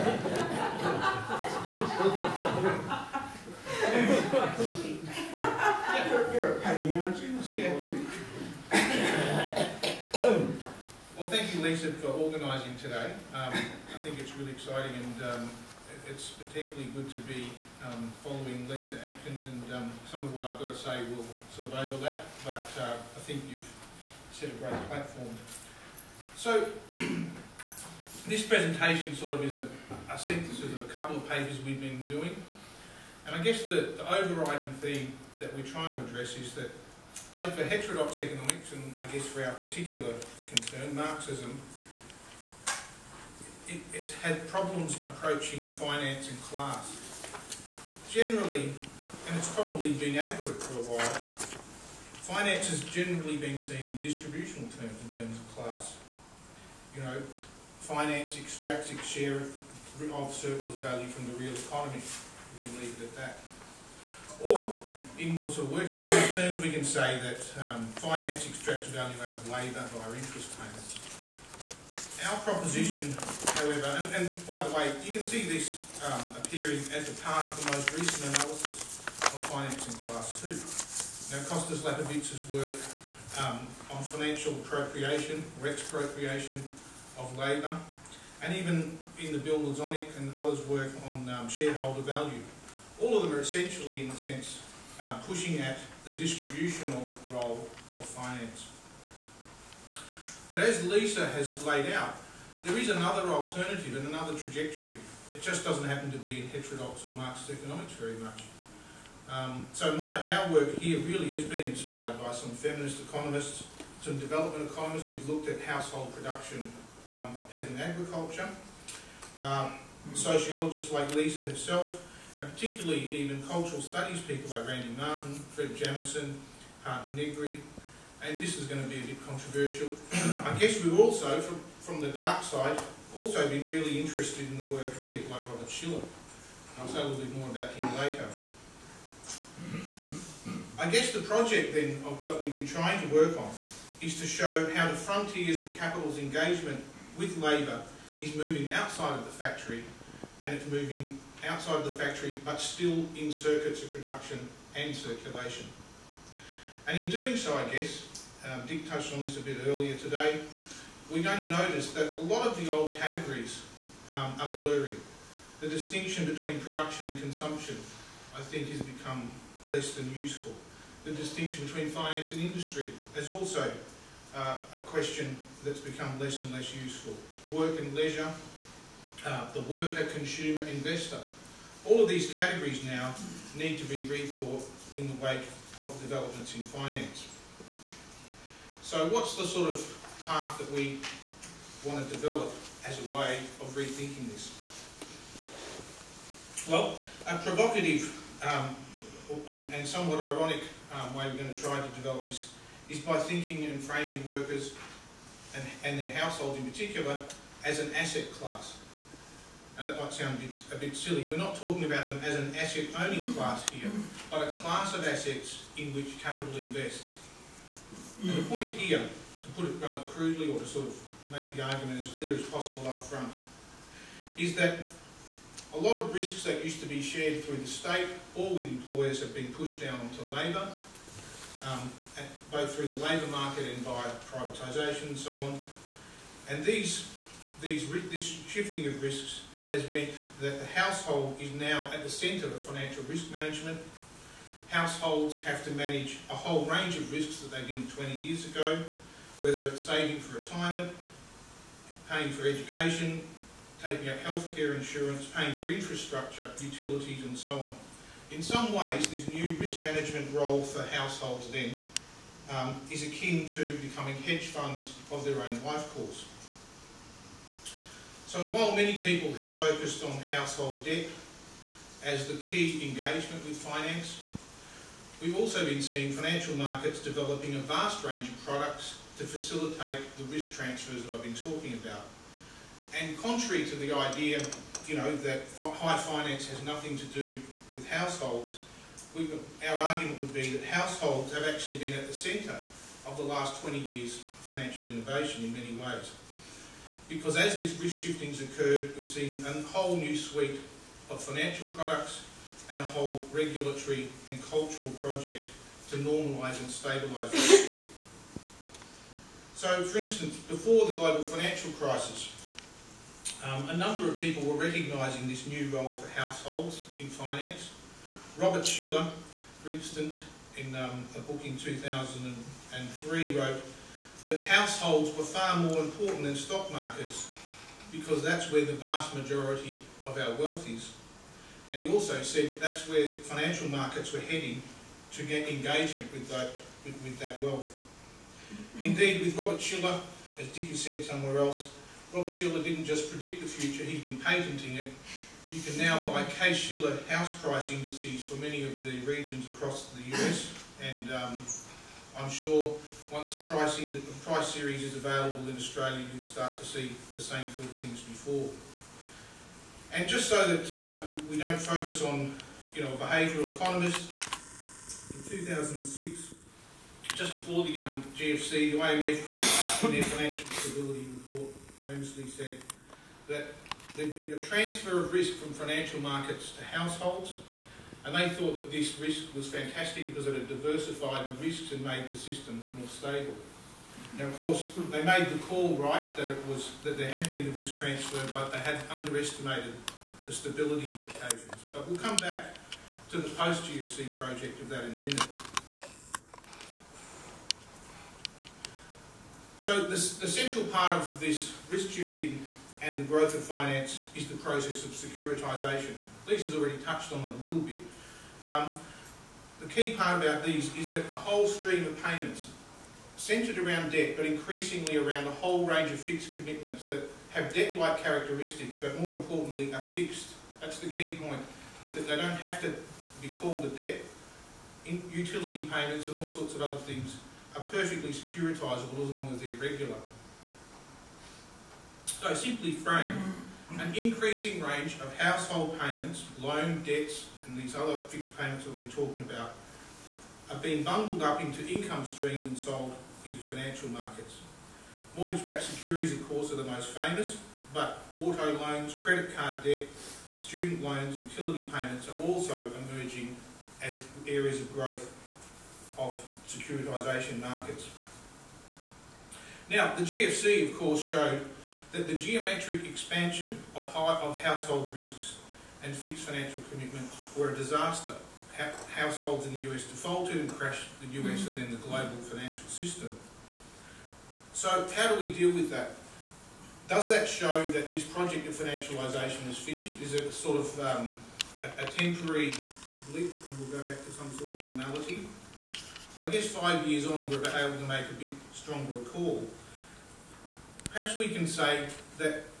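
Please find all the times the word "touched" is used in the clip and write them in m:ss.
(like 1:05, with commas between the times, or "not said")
2:38, 6:46.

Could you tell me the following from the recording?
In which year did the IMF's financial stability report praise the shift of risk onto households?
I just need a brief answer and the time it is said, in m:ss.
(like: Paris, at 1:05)
2006, at 6:05.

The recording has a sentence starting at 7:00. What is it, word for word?
That's the key point, is that they don't have to be called a debt.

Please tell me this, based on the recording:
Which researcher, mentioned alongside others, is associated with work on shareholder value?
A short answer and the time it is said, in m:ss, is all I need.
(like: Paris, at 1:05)
Bill Lazonick, at 1:29.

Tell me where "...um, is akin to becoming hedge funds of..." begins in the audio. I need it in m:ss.
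4:22.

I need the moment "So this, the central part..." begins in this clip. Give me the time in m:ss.
6:39.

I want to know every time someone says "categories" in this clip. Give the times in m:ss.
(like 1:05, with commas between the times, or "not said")
2:42, 3:02.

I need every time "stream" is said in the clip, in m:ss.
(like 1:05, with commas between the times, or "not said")
6:51, 7:22.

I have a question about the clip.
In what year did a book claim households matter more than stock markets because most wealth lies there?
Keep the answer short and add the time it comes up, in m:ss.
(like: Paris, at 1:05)
2003, at 5:21.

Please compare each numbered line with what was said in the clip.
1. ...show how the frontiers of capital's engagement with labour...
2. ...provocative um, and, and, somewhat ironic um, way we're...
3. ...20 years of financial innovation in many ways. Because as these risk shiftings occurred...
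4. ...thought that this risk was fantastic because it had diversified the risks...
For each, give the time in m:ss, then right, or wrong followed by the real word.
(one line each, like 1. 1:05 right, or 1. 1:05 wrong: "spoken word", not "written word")
1. 2:24 right
2. 3:17 right
3. 4:53 right
4. 6:18 right.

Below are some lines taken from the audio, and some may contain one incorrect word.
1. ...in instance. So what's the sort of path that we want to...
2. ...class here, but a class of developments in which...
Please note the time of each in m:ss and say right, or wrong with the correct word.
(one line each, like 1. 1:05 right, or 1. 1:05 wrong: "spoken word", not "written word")
1. 3:06 wrong: "finance", not "instance"
2. 3:33 wrong: "assets", not "developments".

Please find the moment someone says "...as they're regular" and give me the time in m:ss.
7:09.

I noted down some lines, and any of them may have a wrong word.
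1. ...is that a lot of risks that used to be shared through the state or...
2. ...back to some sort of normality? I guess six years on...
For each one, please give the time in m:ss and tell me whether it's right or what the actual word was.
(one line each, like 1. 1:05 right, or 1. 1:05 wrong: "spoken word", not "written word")
1. 3:44 right
2. 8:03 wrong: "five", not "six".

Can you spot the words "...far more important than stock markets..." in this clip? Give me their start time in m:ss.
5:25.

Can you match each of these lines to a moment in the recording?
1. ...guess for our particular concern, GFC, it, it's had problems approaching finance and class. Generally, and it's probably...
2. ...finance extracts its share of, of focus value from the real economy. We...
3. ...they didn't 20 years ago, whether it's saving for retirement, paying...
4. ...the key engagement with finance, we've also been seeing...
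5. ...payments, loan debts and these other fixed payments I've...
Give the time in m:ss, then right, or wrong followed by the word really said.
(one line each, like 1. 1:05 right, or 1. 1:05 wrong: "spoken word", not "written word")
1. 0:39 wrong: "Marxism", not "GFC"
2. 0:57 wrong: "surplus", not "focus"
3. 4:07 right
4. 4:32 right
5. 7:15 right.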